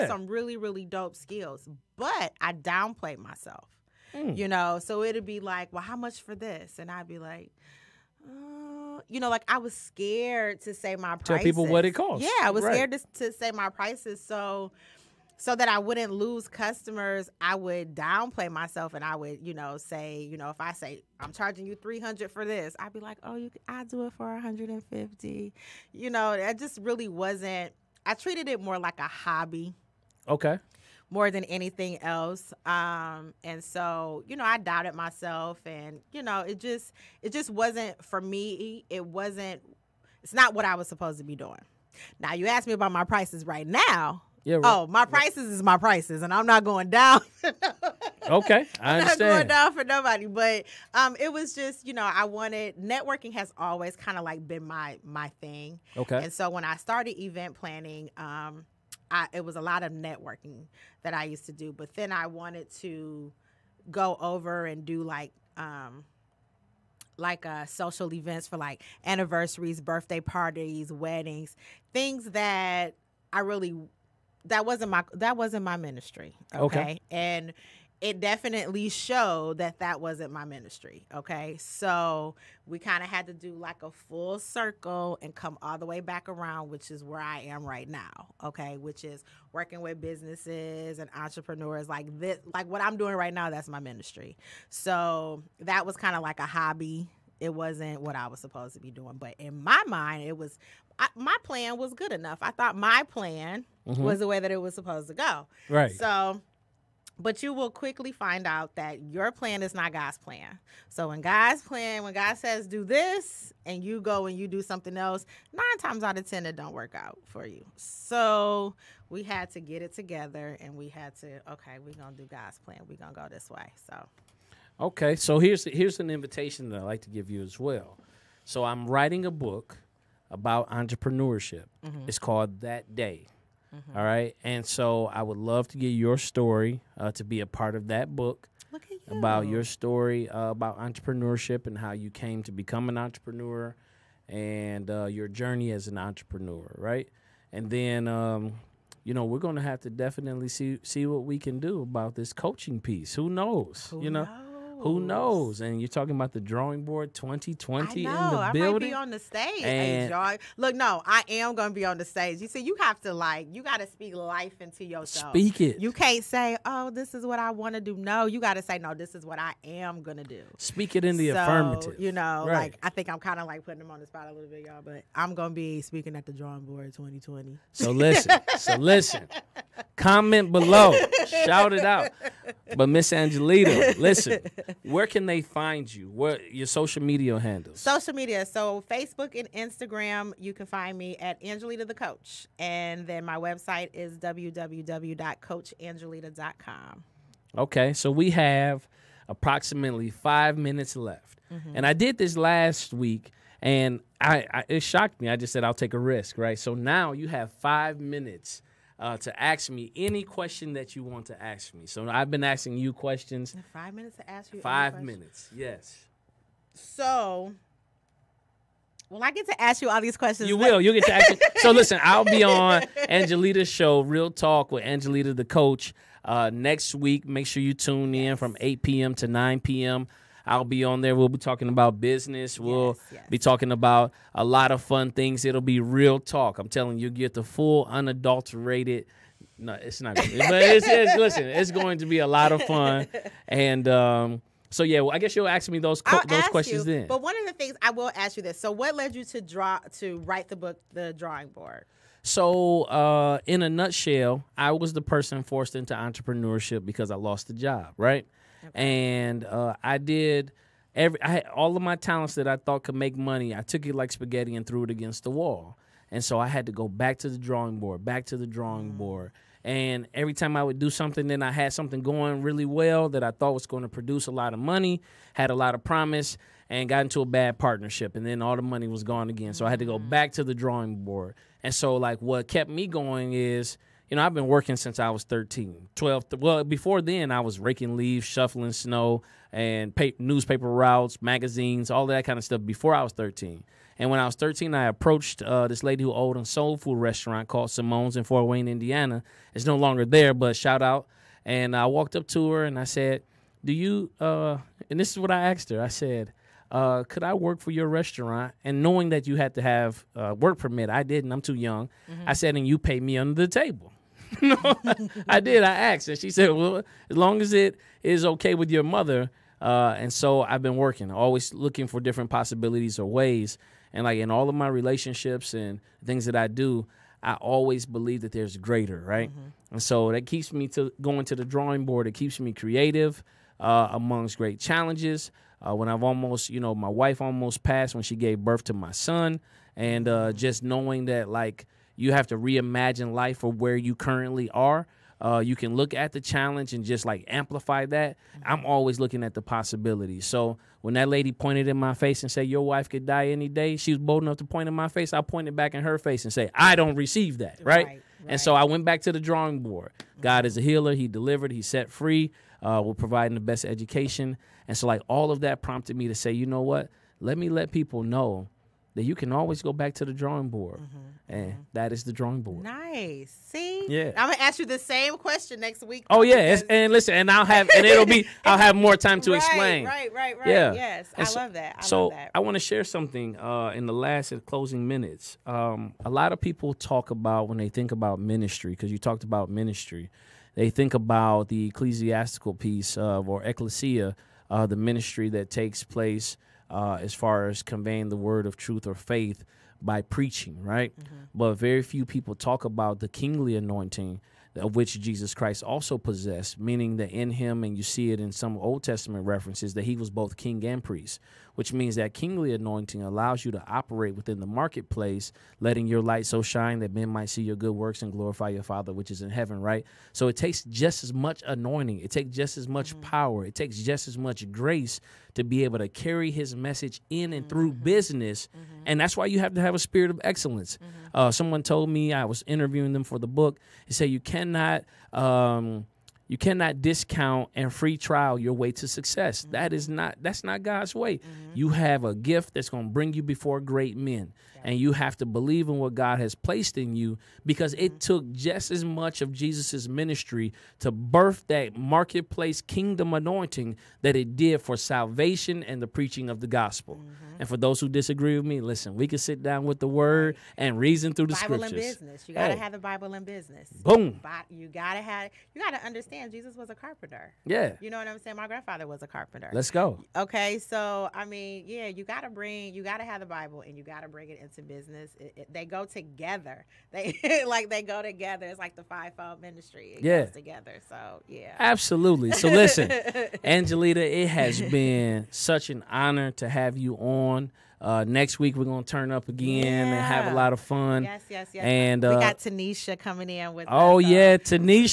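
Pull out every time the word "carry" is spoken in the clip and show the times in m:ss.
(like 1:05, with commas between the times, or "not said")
7:05.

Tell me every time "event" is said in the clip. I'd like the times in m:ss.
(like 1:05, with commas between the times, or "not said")
0:57, 1:08.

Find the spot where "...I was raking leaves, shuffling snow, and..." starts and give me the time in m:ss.
4:47.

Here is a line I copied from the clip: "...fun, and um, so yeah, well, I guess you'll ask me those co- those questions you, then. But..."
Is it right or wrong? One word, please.
right.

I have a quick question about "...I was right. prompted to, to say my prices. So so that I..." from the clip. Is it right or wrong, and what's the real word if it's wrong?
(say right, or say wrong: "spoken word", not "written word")
wrong: "scared", not "prompted".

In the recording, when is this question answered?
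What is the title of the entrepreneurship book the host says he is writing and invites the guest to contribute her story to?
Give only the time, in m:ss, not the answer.
2:12.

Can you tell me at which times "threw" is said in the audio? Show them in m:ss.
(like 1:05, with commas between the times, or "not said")
4:24.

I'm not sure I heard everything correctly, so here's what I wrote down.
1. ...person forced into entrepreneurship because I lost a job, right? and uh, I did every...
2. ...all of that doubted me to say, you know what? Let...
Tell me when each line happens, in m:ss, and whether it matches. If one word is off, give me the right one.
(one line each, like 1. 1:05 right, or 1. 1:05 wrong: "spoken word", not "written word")
1. 4:15 right
2. 6:05 wrong: "prompted", not "doubted".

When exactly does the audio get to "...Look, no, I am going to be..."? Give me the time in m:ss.
2:40.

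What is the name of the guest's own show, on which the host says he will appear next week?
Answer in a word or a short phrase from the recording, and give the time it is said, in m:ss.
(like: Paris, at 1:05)
Real Talk with Angelita, at 3:44.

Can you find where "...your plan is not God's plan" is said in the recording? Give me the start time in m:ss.
1:49.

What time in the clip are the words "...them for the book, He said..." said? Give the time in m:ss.
7:12.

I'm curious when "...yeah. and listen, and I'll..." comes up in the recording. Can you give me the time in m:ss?
6:16.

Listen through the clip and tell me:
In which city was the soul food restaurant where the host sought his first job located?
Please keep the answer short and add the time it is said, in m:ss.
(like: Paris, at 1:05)
Fort Wayne, Indiana, at 4:58.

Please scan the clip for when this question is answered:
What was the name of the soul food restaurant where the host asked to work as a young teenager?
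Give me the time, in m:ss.
4:57.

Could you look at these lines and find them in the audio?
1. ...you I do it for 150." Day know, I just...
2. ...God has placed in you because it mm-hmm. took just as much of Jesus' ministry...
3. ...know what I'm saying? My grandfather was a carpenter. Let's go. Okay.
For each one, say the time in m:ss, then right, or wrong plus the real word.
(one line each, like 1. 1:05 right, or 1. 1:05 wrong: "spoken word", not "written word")
1. 0:23 wrong: "You", not "Day"
2. 7:25 right
3. 7:47 right.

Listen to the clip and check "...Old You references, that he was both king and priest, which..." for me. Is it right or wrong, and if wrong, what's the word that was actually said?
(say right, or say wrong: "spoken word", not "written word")
wrong: "Testament", not "You".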